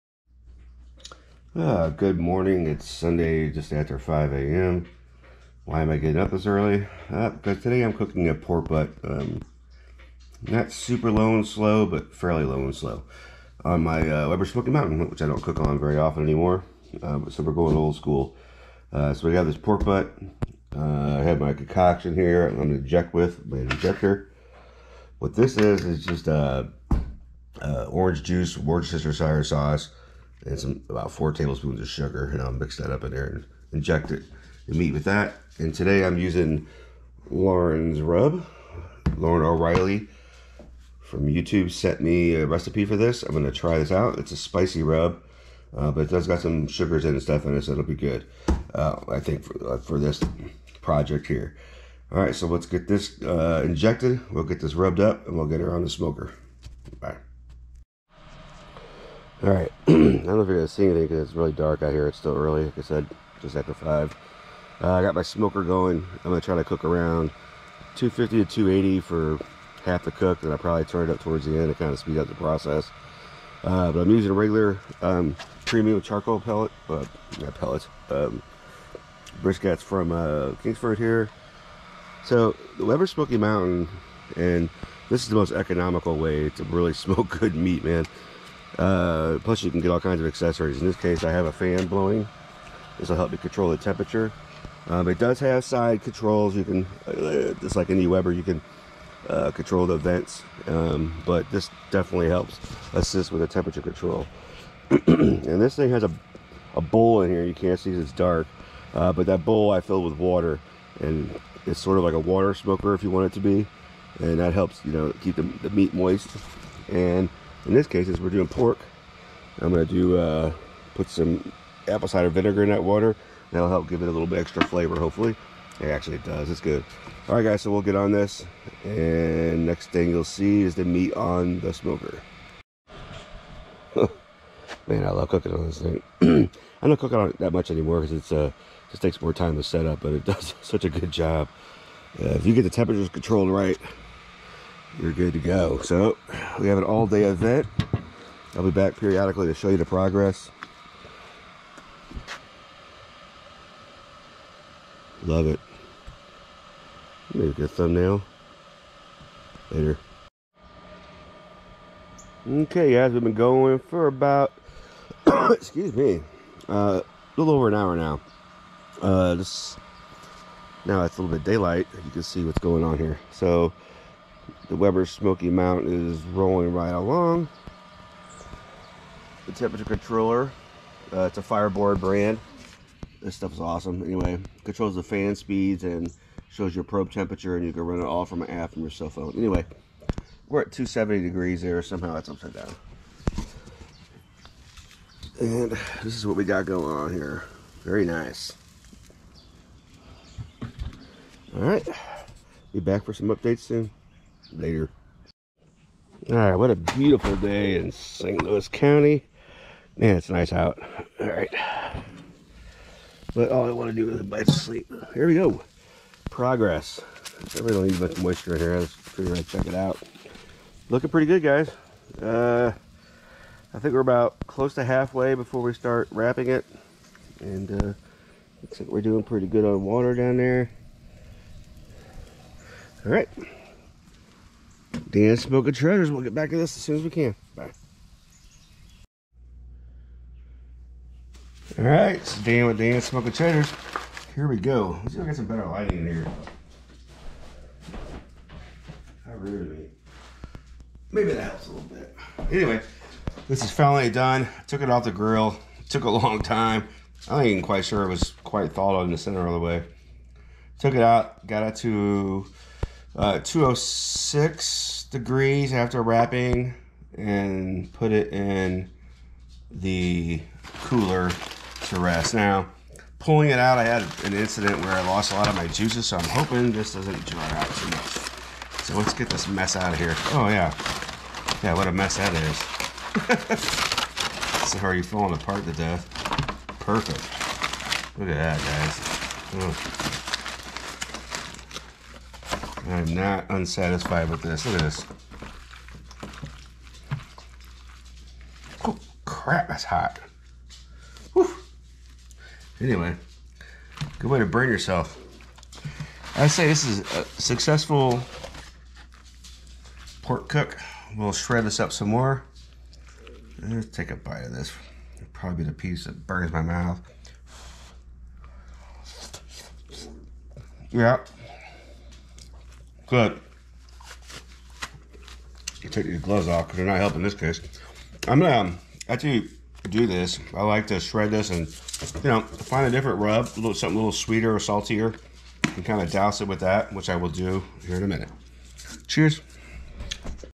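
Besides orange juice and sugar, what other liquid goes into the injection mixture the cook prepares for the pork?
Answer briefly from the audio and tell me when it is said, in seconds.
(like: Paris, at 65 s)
Worcestershire sauce, at 28 s.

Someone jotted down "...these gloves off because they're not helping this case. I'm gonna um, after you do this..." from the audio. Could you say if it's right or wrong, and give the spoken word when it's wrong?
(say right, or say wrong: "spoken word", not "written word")
right.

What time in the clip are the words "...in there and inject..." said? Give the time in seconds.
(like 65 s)
33 s.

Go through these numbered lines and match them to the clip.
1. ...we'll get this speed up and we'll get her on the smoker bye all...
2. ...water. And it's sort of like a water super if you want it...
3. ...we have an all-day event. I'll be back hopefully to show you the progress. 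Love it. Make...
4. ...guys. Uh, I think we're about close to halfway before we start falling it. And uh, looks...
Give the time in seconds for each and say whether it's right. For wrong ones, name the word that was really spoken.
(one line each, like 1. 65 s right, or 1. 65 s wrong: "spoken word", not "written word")
1. 54 s wrong: "rubbed", not "speed"
2. 110 s wrong: "smoker", not "super"
3. 146 s wrong: "periodically", not "hopefully"
4. 221 s wrong: "wrapping", not "falling".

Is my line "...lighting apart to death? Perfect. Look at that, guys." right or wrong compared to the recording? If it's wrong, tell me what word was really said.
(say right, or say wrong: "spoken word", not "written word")
wrong: "falling", not "lighting".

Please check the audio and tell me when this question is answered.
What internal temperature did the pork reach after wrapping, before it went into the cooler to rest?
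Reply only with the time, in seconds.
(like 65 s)
263 s.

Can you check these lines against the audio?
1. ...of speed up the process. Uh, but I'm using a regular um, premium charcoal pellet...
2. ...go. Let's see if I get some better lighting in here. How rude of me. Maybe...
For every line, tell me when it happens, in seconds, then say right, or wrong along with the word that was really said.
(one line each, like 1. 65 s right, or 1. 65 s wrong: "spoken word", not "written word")
1. 71 s right
2. 244 s right.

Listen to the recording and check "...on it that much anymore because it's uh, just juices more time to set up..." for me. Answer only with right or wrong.
wrong.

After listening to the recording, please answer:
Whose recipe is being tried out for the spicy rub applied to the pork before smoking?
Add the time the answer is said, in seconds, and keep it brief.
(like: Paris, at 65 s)
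Lauren O'Reilly, at 39 s.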